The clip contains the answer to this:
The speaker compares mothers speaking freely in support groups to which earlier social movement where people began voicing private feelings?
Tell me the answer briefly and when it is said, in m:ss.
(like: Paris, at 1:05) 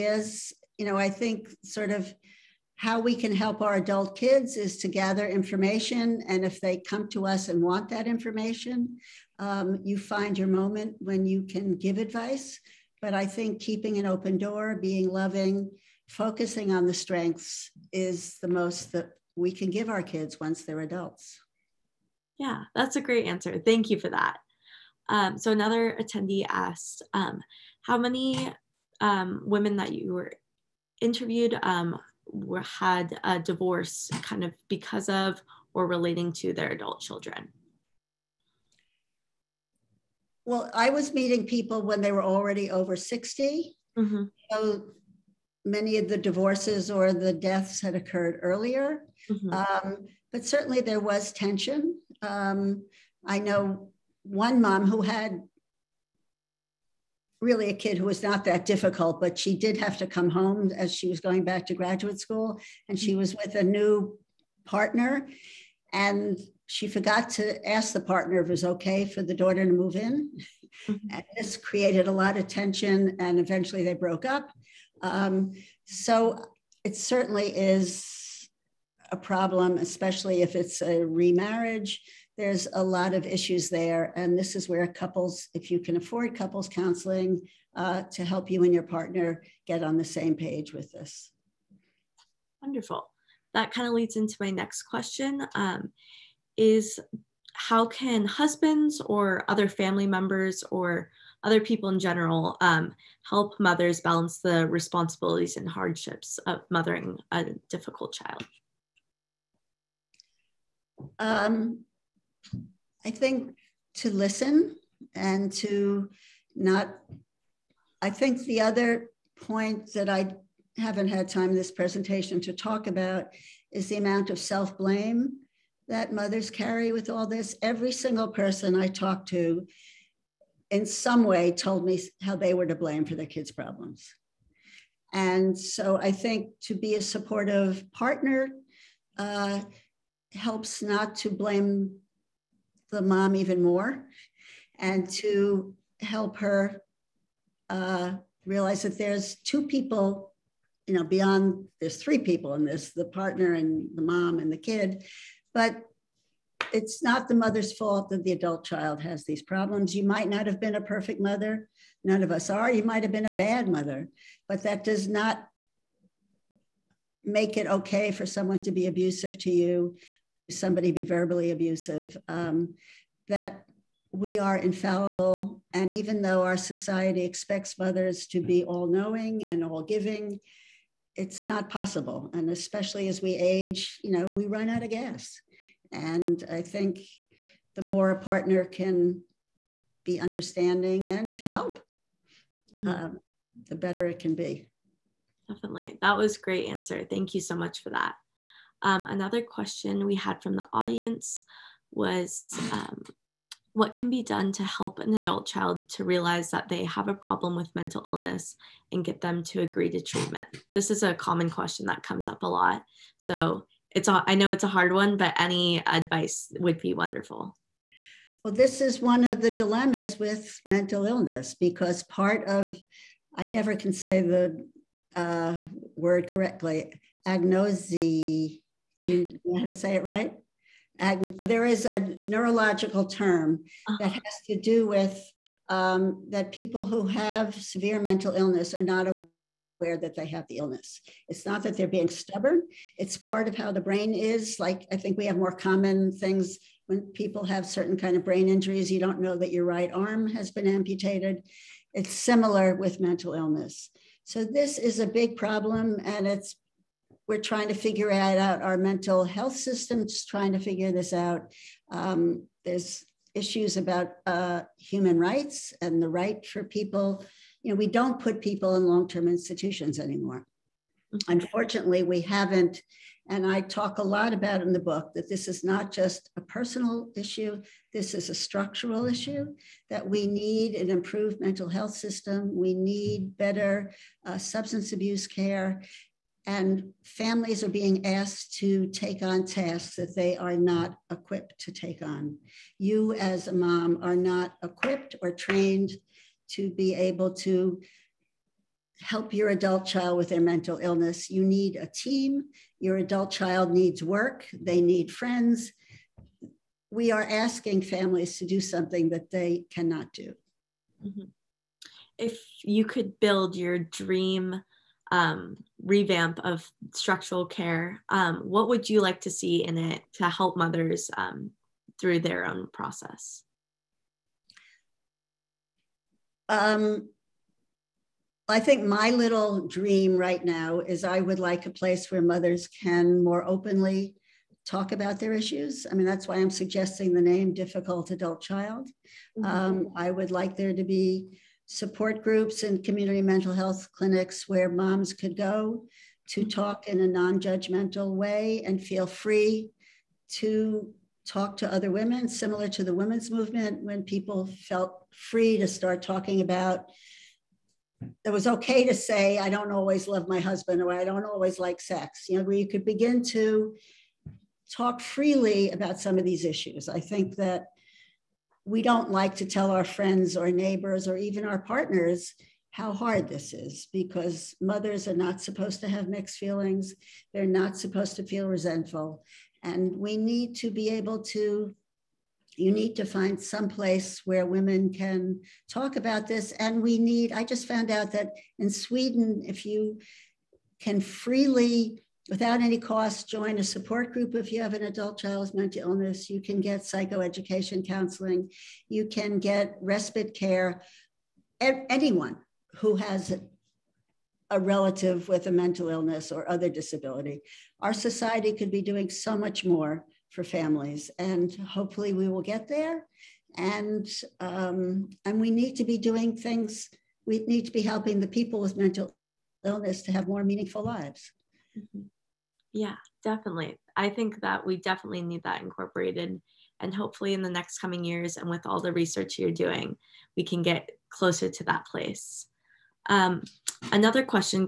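the women's movement, at 5:52.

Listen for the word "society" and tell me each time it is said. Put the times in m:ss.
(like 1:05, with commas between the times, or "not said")
2:56, 6:47.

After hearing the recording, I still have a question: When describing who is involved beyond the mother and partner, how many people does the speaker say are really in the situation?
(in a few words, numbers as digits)
3.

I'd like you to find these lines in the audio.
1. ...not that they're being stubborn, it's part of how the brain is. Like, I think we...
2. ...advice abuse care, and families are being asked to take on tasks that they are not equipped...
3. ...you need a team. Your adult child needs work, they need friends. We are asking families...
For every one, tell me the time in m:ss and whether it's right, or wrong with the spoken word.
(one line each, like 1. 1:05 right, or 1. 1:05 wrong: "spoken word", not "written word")
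1. 4:01 right
2. 4:44 wrong: "substance", not "advice"
3. 5:01 right.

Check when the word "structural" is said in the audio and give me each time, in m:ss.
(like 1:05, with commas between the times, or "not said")
4:38, 5:16.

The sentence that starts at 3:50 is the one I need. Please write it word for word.
Ag- there is a neurological term uh-huh.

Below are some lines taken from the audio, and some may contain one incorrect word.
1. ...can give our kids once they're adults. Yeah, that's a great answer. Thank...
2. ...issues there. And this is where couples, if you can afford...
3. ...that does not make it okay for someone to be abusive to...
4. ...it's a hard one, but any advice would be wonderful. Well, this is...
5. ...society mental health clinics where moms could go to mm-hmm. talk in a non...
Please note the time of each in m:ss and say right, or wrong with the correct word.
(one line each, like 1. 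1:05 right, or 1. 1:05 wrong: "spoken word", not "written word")
1. 0:19 right
2. 1:23 right
3. 2:44 right
4. 3:34 right
5. 5:42 wrong: "community", not "society".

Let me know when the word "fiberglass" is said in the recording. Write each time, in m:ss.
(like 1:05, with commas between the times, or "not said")
not said.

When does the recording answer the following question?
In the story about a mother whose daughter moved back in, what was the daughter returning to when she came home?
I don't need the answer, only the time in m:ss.
1:01.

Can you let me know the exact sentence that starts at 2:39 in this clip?
You might not have been a perfect mother.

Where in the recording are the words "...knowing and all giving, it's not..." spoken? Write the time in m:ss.
2:58.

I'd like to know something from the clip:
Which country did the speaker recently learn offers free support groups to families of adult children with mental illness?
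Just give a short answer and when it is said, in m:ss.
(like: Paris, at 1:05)
Sweden, at 6:28.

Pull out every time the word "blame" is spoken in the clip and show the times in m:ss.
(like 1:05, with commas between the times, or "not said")
2:04, 2:12, 2:21.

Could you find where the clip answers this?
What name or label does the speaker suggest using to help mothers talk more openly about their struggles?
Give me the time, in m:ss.
5:37.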